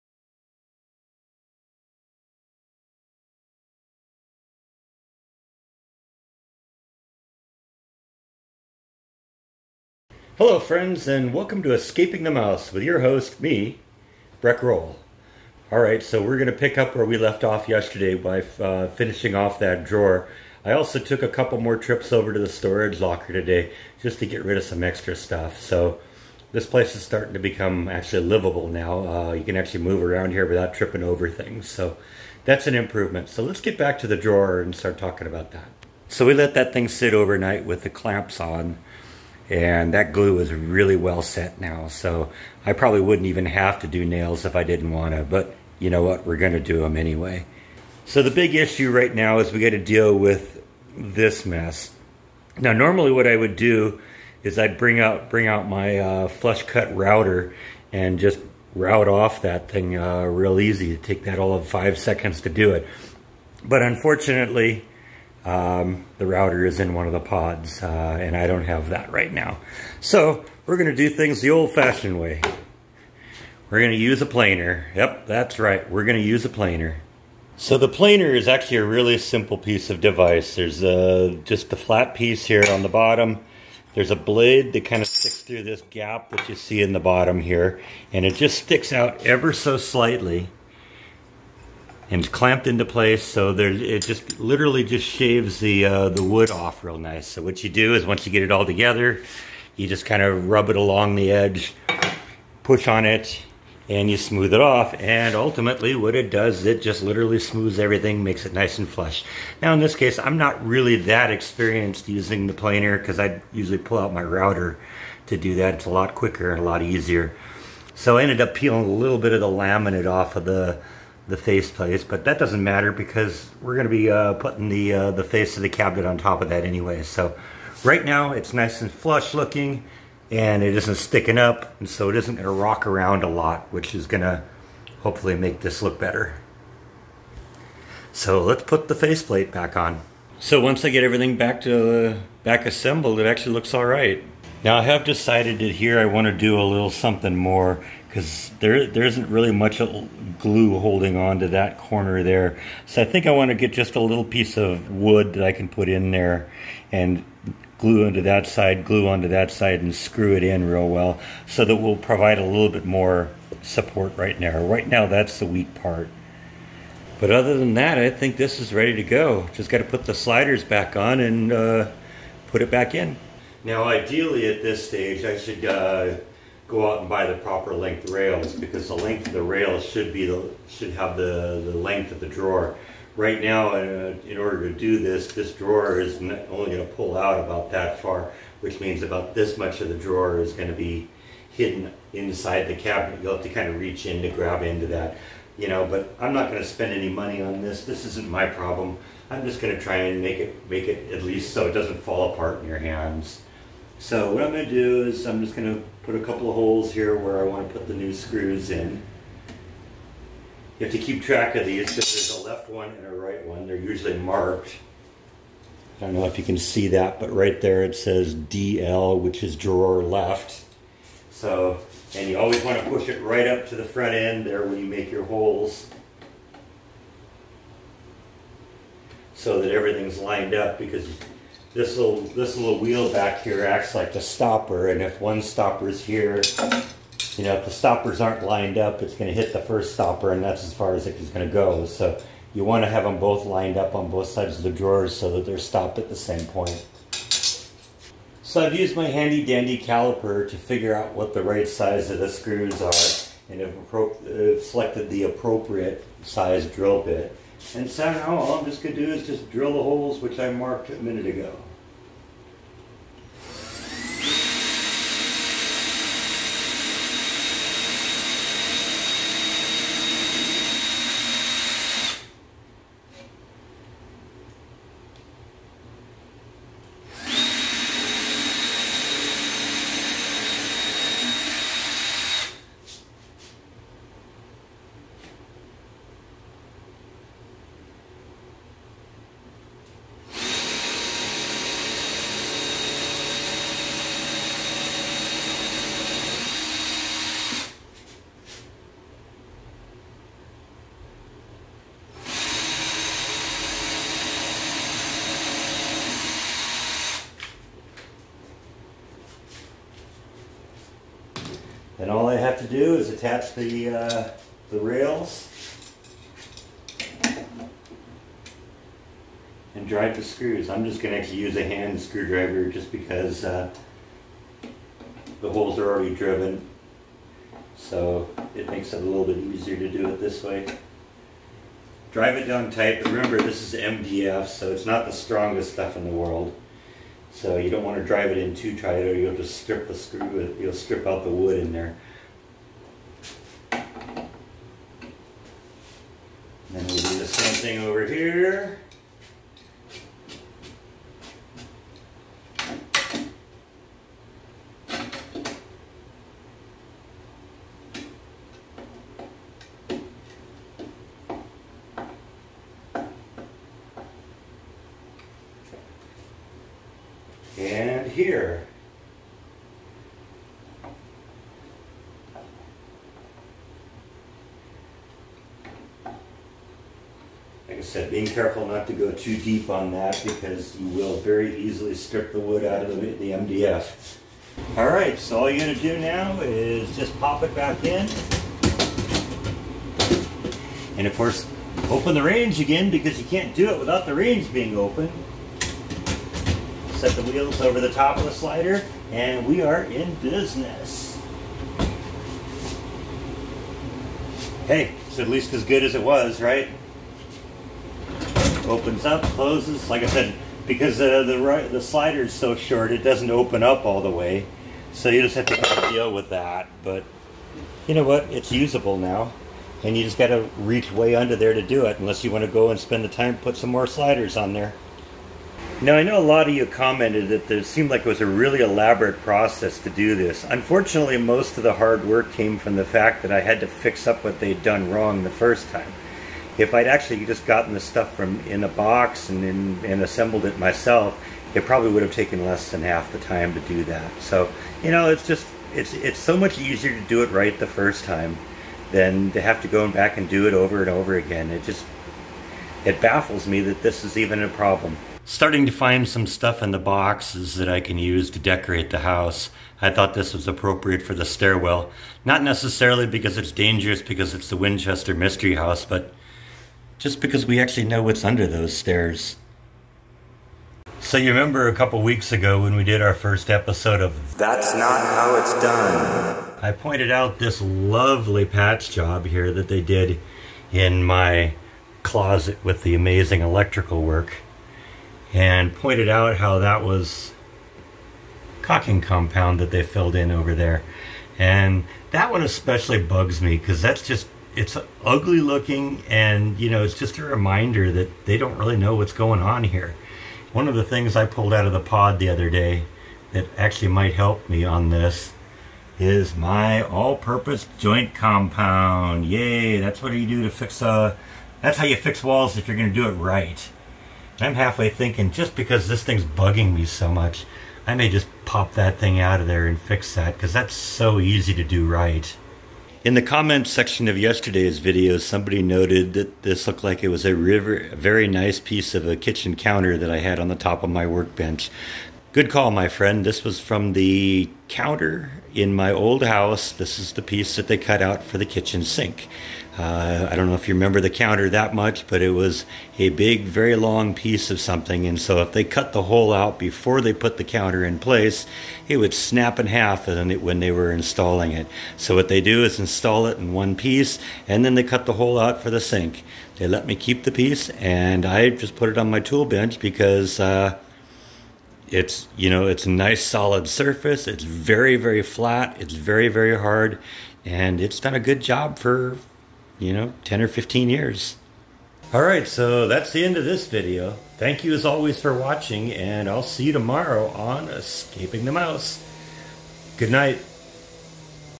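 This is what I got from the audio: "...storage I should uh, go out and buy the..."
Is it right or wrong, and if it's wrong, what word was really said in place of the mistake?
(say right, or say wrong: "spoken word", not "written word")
wrong: "stage", not "storage".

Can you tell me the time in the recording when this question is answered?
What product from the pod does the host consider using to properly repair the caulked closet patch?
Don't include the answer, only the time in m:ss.
8:26.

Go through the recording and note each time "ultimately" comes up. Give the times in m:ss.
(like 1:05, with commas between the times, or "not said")
1:45.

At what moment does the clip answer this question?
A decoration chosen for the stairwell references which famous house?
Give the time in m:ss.
7:44.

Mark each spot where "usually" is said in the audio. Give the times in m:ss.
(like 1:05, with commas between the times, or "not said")
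1:53, 3:33.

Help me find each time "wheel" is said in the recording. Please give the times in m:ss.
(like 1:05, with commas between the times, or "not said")
3:52, 6:37.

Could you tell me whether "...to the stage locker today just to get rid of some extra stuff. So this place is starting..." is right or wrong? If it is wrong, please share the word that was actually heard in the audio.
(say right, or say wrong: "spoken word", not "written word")
wrong: "storage", not "stage".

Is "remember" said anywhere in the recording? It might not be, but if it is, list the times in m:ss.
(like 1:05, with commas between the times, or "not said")
5:33, 7:51, 9:00.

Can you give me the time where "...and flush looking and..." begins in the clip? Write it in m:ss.
2:08.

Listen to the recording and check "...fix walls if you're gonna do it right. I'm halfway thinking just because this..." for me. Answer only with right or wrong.
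right.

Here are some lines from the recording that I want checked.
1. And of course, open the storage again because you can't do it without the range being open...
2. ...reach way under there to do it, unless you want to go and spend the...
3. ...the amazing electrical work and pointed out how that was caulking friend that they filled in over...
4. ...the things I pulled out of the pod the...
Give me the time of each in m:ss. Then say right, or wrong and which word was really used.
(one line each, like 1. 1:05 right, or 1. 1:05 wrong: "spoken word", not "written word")
1. 6:30 wrong: "range", not "storage"
2. 7:00 right
3. 8:02 wrong: "compound", not "friend"
4. 8:20 right.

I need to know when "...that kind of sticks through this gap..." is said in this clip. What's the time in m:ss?
1:24.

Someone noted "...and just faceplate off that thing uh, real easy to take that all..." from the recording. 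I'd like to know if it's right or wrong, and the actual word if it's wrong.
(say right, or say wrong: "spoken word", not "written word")
wrong: "route", not "faceplate".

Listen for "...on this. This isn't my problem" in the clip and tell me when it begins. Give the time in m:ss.
3:17.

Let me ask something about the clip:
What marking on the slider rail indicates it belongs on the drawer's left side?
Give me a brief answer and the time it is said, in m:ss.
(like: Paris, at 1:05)
DL, at 3:38.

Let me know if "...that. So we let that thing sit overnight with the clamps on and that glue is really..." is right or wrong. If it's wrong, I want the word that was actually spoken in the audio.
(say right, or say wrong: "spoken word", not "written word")
right.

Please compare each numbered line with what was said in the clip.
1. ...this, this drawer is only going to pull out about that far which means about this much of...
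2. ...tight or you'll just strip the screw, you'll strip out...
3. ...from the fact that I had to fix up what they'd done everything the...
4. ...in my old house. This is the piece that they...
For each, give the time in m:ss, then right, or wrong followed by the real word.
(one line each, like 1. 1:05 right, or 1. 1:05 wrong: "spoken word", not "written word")
1. 3:04 right
2. 5:38 right
3. 7:12 wrong: "wrong", not "everything"
4. 8:55 right.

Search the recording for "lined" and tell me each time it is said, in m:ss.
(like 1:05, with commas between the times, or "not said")
3:50, 3:58, 4:03.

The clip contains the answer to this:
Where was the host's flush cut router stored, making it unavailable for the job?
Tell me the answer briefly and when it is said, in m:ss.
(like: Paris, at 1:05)
in one of the pods, at 1:06.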